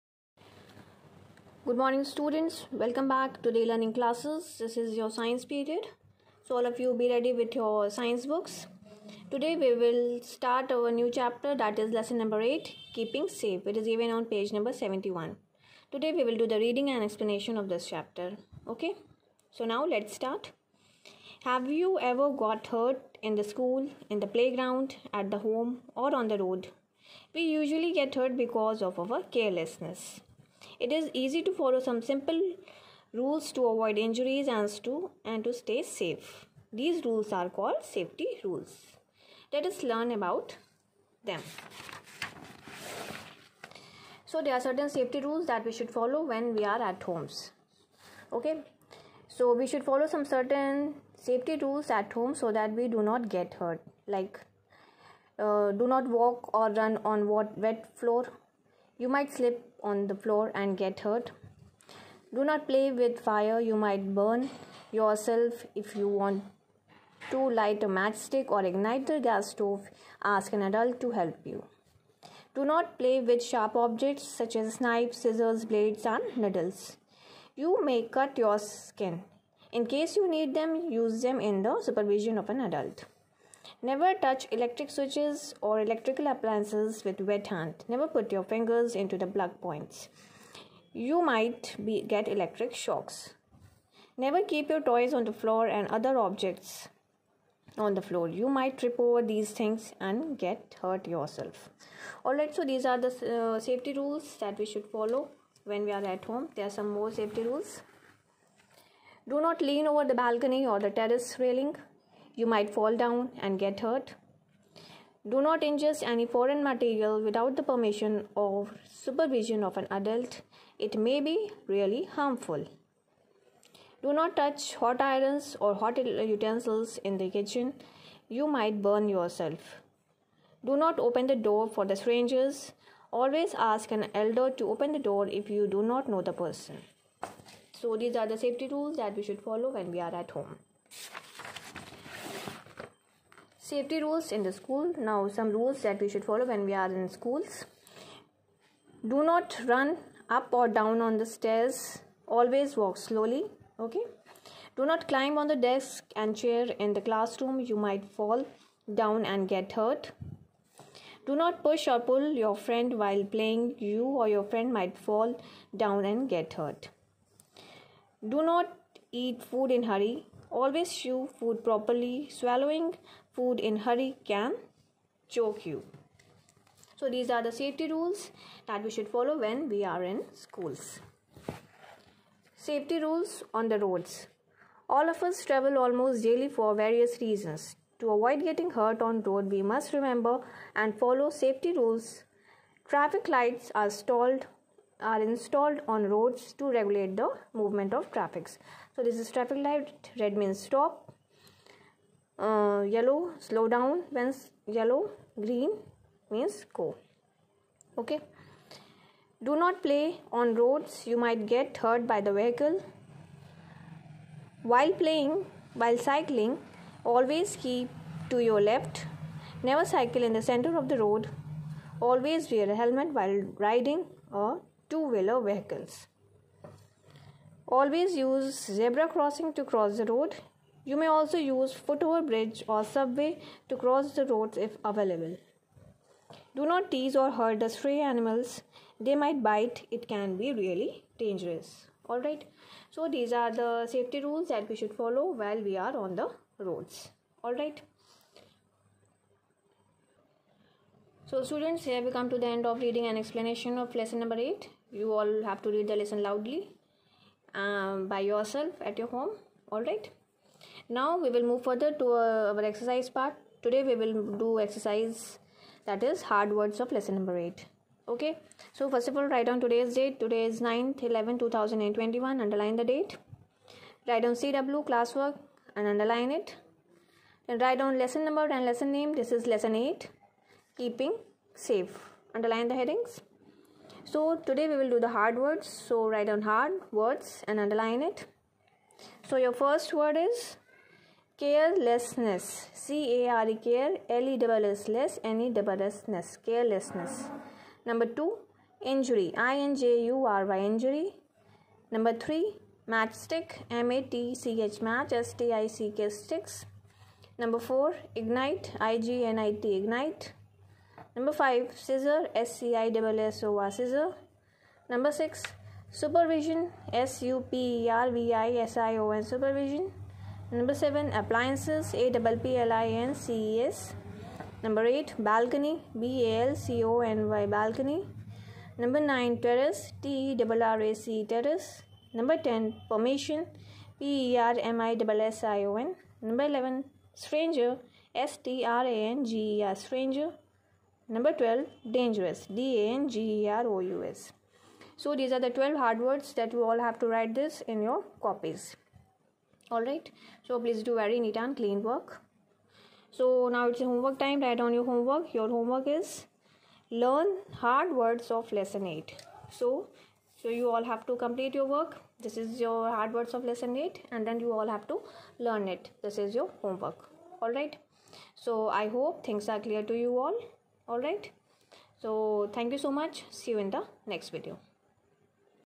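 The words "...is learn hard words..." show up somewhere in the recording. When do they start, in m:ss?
5:55.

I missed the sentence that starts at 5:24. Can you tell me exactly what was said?
Number 8 balcony B A L C O N Y balcony.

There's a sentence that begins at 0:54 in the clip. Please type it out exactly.
Like uh, do not walk or run on wet floor you might slip on the floor and get hurt.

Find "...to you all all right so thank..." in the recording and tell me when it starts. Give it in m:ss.
6:09.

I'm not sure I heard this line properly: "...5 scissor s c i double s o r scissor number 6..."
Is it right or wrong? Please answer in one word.
right.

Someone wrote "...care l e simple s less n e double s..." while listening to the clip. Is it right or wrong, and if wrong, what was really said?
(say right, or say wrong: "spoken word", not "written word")
wrong: "double", not "simple".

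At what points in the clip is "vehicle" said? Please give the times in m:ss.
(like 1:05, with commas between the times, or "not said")
3:32, 3:45.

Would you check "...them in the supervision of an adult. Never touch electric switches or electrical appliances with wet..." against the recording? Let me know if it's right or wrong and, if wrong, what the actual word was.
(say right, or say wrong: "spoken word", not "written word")
right.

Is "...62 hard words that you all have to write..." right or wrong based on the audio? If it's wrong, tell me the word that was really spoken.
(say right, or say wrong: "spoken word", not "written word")
wrong: "12", not "62".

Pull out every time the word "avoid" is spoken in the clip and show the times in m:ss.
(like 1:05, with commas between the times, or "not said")
0:33, 3:08.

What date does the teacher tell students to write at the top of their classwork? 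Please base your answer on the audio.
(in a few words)
9/11/2021.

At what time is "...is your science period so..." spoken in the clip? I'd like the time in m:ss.
0:04.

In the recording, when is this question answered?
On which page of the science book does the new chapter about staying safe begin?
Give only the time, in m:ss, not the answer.
0:14.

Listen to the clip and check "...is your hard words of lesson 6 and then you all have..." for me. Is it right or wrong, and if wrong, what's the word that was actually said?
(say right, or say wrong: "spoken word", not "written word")
wrong: "8", not "6".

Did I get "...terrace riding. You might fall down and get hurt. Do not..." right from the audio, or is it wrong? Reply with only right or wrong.
wrong.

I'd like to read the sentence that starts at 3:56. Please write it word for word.
Do not tease or hurt the stray animals.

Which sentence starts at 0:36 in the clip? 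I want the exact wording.
These rules are called safety rules.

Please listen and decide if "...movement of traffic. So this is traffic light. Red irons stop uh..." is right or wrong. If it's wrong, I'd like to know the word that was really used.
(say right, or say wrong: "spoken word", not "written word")
wrong: "means", not "irons".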